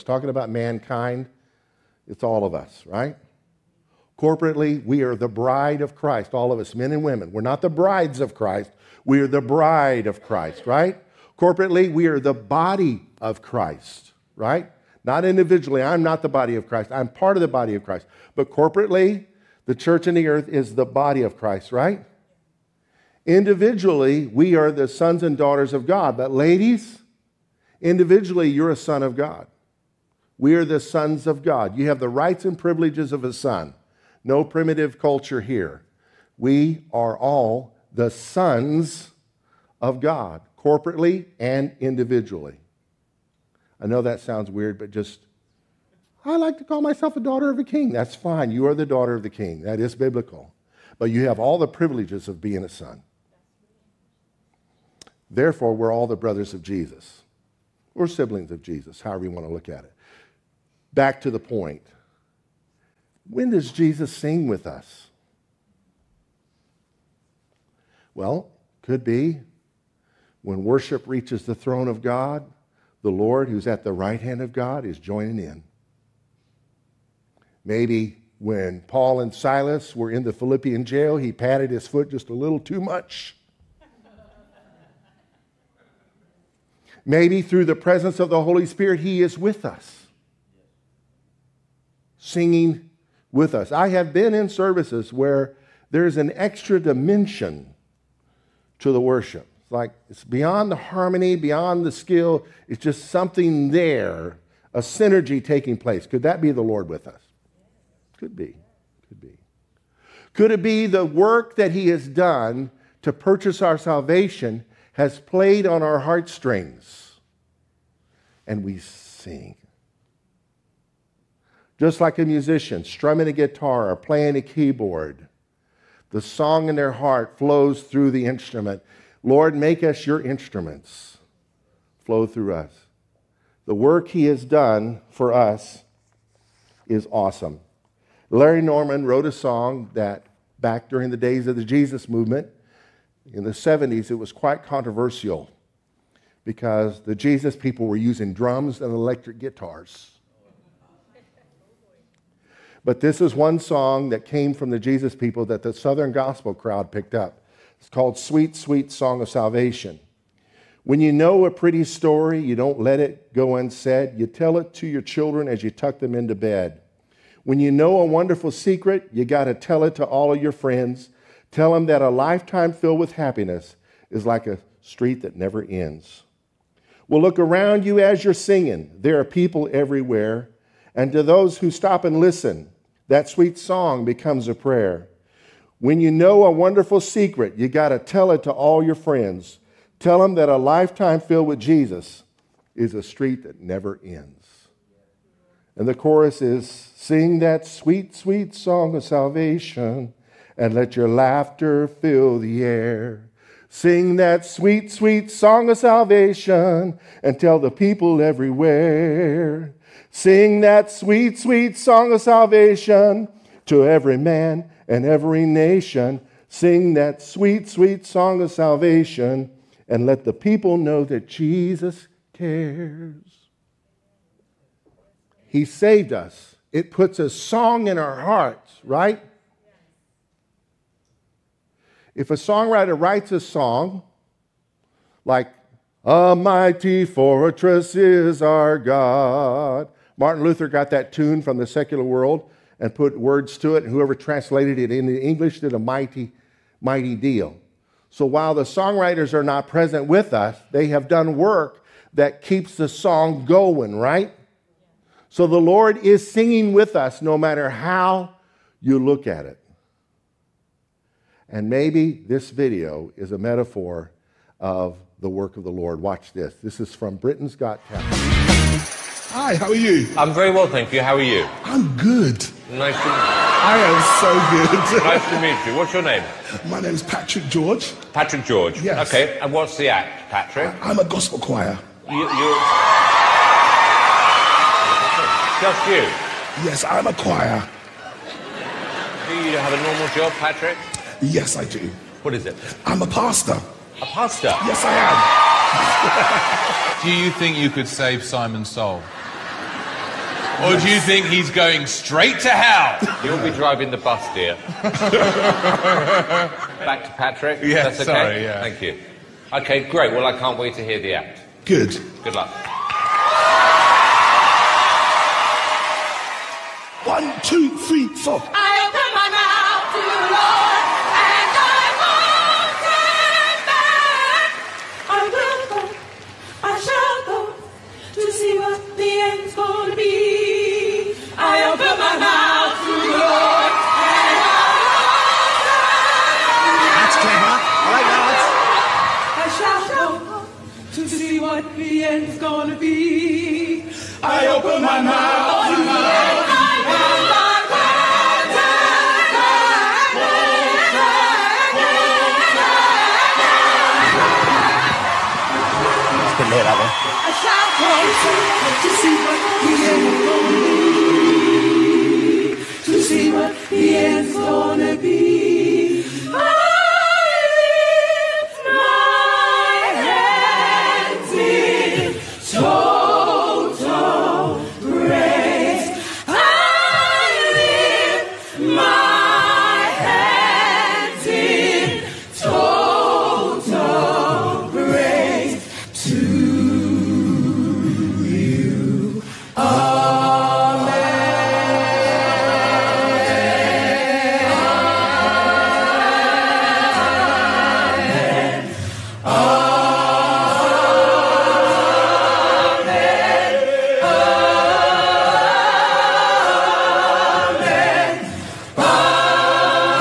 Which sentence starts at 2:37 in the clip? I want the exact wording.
It's called Sweet, Sweet Song of Salvation.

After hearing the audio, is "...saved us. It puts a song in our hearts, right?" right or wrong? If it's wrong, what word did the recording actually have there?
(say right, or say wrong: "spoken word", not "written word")
right.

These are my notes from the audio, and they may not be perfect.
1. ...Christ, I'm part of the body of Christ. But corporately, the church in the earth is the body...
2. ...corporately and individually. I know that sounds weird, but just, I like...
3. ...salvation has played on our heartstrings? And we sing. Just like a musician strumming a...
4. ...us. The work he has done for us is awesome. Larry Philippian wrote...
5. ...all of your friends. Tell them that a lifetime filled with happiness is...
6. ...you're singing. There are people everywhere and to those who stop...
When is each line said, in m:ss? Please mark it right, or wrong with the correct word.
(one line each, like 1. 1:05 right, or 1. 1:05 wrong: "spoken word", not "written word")
1. 0:16 right
2. 0:40 right
3. 1:53 right
4. 2:12 wrong: "Norman", not "Philippian"
5. 2:50 right
6. 2:58 right.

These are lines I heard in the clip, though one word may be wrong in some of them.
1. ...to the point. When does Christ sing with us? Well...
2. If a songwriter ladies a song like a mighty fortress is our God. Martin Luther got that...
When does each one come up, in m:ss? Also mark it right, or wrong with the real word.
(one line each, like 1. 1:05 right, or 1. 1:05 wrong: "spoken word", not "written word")
1. 1:01 wrong: "Jesus", not "Christ"
2. 3:52 wrong: "writes", not "ladies".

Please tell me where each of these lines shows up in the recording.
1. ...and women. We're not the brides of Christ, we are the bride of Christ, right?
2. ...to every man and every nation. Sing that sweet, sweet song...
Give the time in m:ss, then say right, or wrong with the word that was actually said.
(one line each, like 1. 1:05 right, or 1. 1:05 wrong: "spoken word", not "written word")
1. 0:06 right
2. 3:33 right.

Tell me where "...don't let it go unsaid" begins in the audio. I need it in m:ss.
2:42.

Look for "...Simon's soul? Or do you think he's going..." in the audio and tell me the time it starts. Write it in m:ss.
4:58.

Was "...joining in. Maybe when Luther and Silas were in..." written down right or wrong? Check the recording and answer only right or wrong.
wrong.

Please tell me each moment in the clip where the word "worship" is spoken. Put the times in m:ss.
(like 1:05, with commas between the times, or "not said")
1:10, 1:39.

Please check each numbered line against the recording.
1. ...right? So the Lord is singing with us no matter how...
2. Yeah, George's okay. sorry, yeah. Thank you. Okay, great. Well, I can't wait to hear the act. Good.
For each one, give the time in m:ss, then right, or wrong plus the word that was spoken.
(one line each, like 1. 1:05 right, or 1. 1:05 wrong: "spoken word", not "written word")
1. 4:13 right
2. 5:07 wrong: "That", not "George".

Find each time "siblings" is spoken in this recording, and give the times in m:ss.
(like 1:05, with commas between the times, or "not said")
0:58.